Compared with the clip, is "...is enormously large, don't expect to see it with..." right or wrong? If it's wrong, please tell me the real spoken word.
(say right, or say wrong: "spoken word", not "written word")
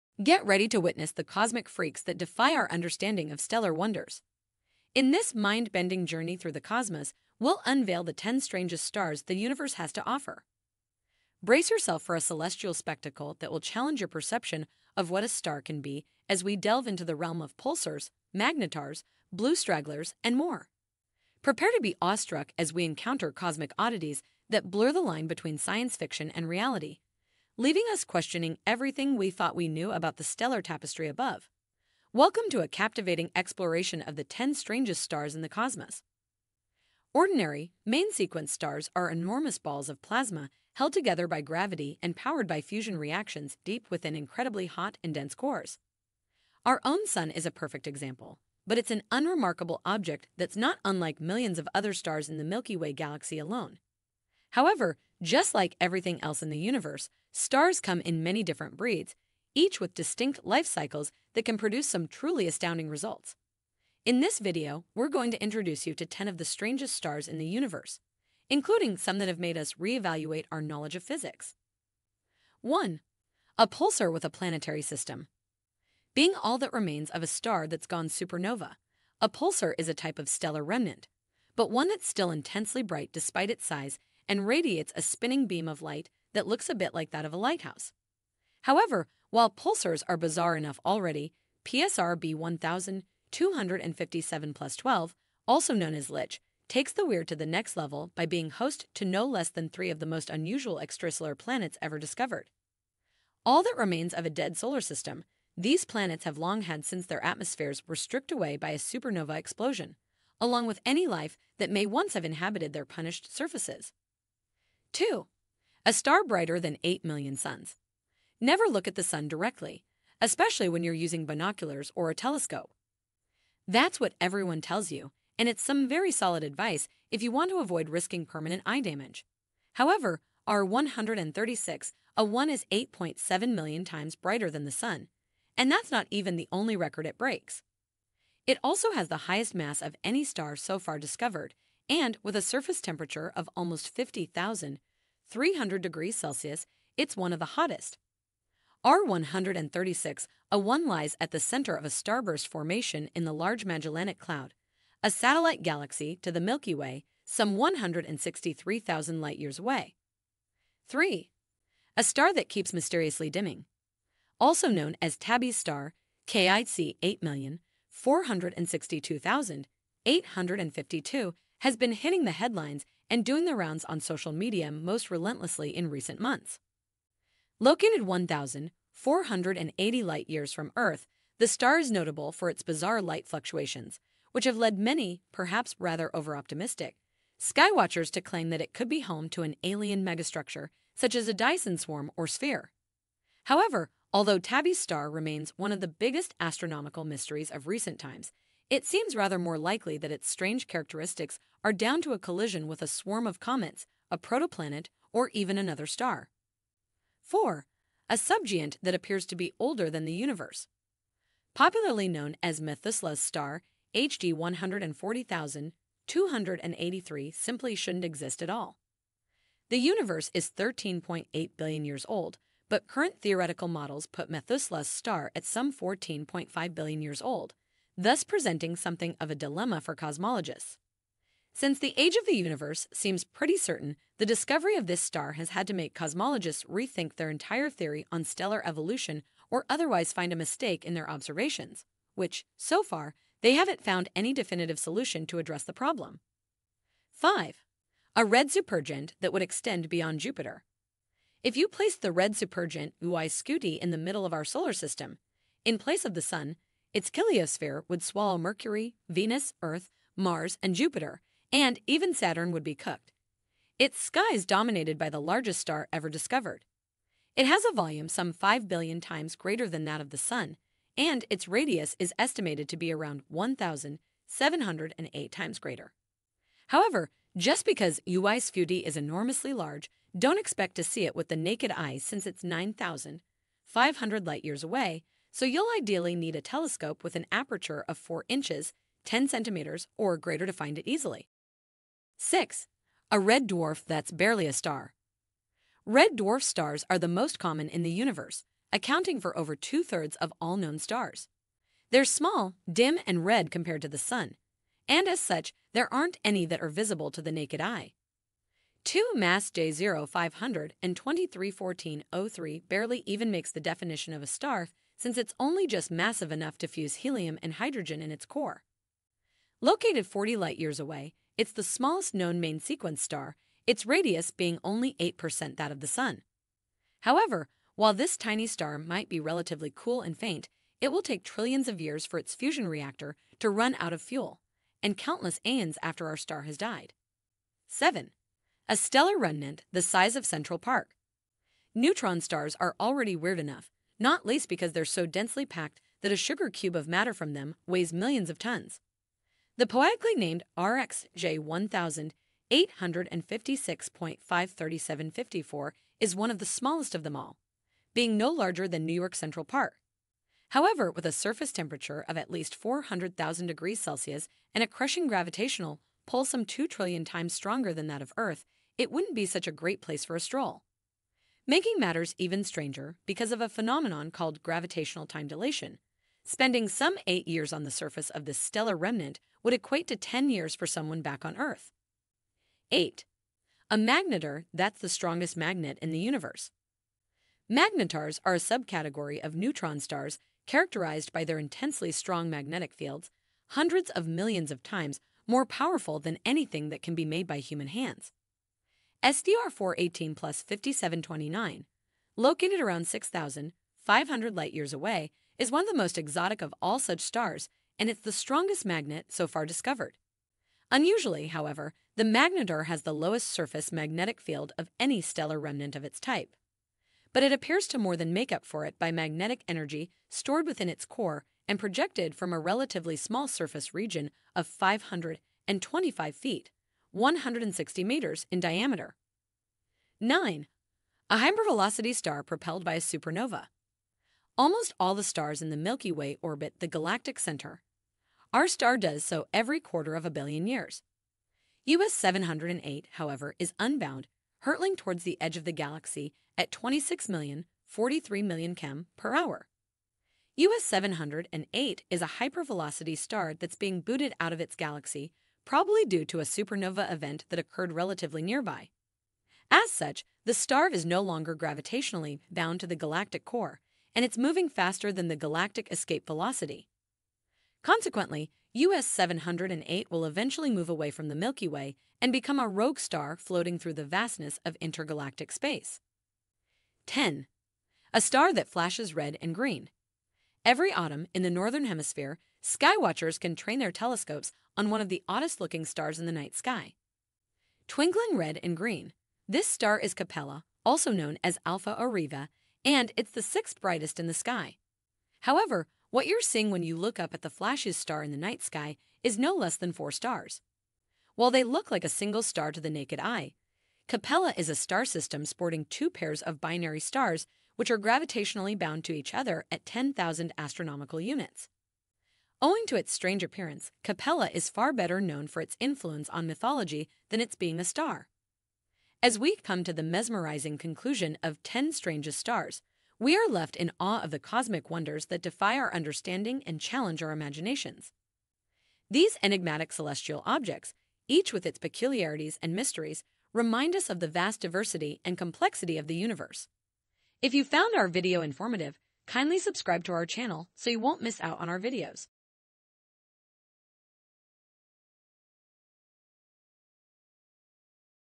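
right.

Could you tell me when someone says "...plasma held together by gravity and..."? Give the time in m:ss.
0:40.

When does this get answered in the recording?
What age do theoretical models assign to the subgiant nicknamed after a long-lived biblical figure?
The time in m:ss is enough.
3:45.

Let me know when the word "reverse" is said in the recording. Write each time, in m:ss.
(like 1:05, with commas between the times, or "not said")
not said.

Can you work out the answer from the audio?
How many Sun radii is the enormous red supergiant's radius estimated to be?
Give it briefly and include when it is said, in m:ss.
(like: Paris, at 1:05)
1,708, at 4:33.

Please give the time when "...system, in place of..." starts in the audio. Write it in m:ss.
4:14.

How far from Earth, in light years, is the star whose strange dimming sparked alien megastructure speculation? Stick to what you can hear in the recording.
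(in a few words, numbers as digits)
1,480 light years.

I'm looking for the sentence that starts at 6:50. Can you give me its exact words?
Unusually, however, the magnetar has the lowest surface magnetic field of any stellar remnant of its type.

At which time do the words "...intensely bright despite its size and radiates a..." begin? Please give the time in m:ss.
1:22.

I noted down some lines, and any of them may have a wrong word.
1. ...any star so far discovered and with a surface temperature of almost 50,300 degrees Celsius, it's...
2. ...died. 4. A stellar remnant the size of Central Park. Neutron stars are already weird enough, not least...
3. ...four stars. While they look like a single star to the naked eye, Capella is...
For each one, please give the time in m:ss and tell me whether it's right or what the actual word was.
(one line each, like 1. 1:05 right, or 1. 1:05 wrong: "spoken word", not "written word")
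1. 2:20 right
2. 5:36 wrong: "7", not "4"
3. 8:19 right.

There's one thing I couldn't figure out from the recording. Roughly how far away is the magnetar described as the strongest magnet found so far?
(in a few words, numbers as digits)
6,500 light years.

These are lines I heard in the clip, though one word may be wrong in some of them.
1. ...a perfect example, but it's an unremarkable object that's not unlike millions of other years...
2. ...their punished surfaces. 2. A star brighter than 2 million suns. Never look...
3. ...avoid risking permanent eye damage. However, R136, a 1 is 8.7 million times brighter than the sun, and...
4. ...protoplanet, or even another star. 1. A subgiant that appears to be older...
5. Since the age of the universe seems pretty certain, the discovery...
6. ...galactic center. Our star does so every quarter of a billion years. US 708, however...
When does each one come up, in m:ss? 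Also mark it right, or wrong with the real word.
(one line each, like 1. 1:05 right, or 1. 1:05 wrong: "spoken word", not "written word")
1. 0:47 wrong: "stars", not "years"
2. 1:52 wrong: "8", not "2"
3. 2:07 right
4. 3:24 wrong: "4", not "1"
5. 3:51 right
6. 7:16 right.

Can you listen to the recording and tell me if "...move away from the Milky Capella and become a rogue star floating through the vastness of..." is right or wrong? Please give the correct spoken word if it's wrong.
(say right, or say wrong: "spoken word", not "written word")
wrong: "Way", not "Capella".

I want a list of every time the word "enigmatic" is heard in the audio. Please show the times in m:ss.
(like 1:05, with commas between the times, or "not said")
8:49.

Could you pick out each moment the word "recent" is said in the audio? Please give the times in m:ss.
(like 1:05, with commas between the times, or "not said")
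2:55, 3:17.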